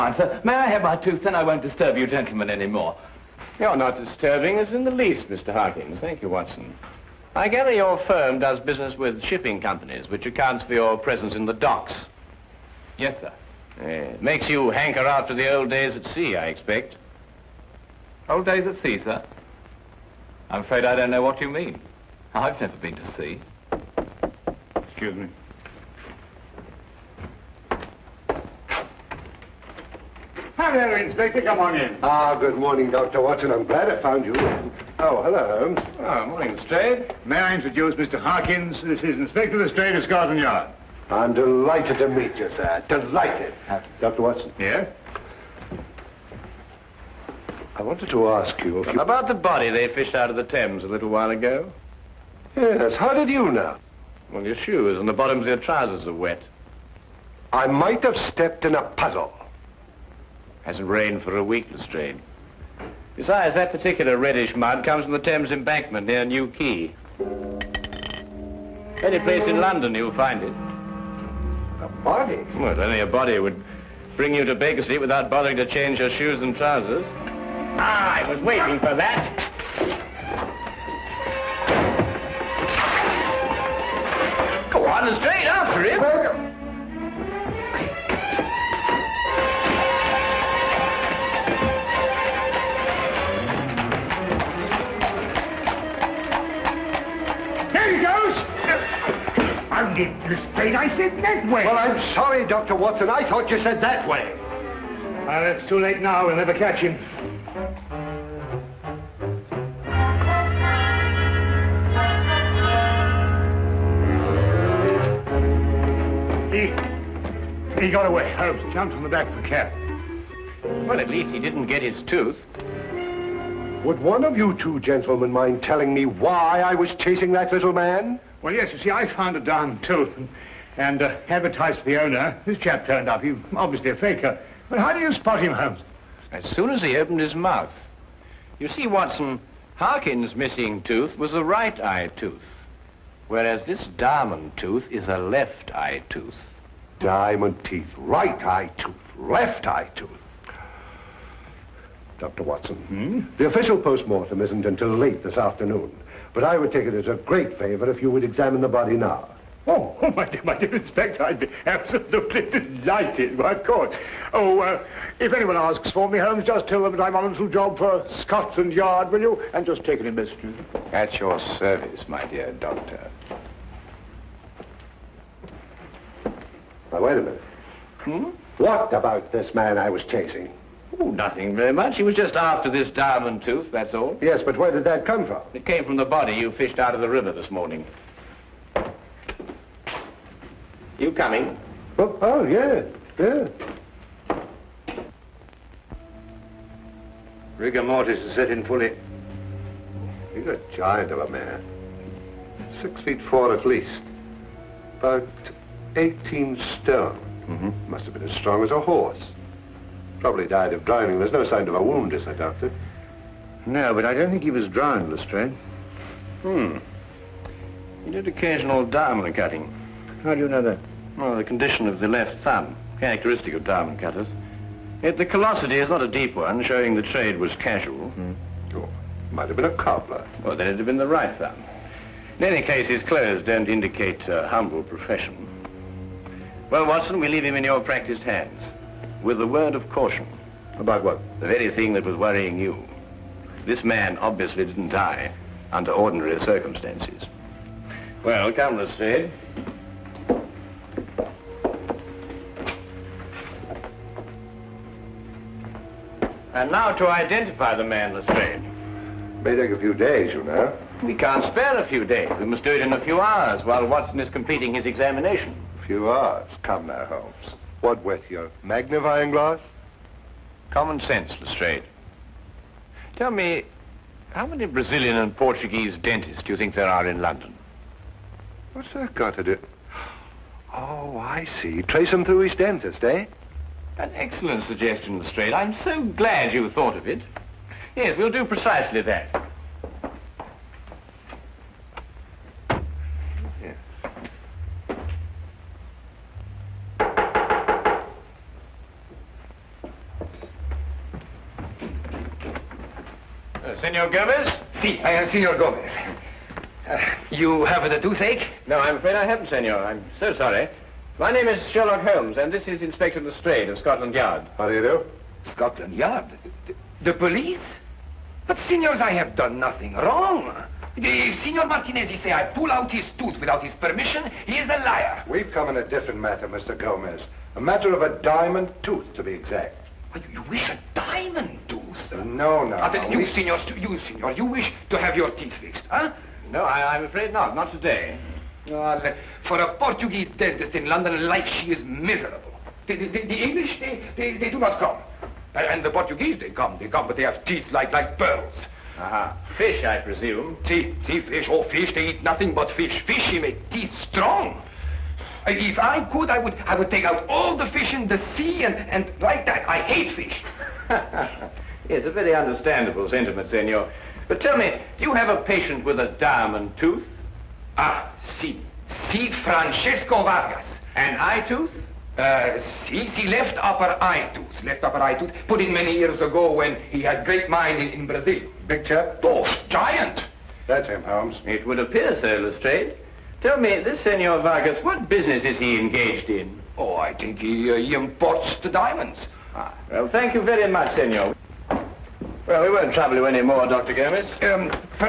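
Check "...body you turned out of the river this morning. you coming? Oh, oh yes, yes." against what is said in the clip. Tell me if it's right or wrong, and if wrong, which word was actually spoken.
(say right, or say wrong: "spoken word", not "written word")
wrong: "fished", not "turned".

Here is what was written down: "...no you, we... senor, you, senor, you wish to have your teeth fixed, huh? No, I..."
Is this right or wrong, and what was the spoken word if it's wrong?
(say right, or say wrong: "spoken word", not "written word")
right.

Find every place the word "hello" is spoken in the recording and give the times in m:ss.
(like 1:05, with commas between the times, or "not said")
0:30, 0:35.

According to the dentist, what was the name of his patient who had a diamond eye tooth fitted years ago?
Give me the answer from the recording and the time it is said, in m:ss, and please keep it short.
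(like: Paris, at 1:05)
Francesco Vargas, at 6:09.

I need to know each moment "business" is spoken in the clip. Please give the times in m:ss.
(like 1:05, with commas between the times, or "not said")
0:08, 6:25.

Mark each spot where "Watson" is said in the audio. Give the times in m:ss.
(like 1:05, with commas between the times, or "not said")
0:06, 0:33, 0:44, 1:42, 2:18, 2:32, 3:56, 4:23.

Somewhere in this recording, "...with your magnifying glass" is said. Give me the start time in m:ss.
4:28.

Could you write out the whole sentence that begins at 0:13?
it uh, makes you hanker after the old days at sea, I expect.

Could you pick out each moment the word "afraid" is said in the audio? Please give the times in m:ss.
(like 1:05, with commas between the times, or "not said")
0:20, 5:08, 5:37.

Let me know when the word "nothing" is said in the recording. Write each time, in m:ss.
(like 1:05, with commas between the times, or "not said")
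3:01, 5:19, 5:52.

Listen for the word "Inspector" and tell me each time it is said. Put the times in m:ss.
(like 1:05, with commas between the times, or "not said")
0:30, 0:39, 2:40, 5:12.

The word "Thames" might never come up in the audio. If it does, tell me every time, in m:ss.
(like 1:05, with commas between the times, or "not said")
0:50, 1:05.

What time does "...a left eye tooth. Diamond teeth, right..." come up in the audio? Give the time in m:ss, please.
2:25.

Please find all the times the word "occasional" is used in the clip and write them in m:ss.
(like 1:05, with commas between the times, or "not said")
3:38.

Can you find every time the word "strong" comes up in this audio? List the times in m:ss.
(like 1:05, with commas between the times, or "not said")
3:28, 5:54.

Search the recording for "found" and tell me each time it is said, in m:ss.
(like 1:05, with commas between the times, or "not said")
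0:34, 2:09.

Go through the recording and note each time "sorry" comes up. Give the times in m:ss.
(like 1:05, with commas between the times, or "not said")
1:42, 5:10.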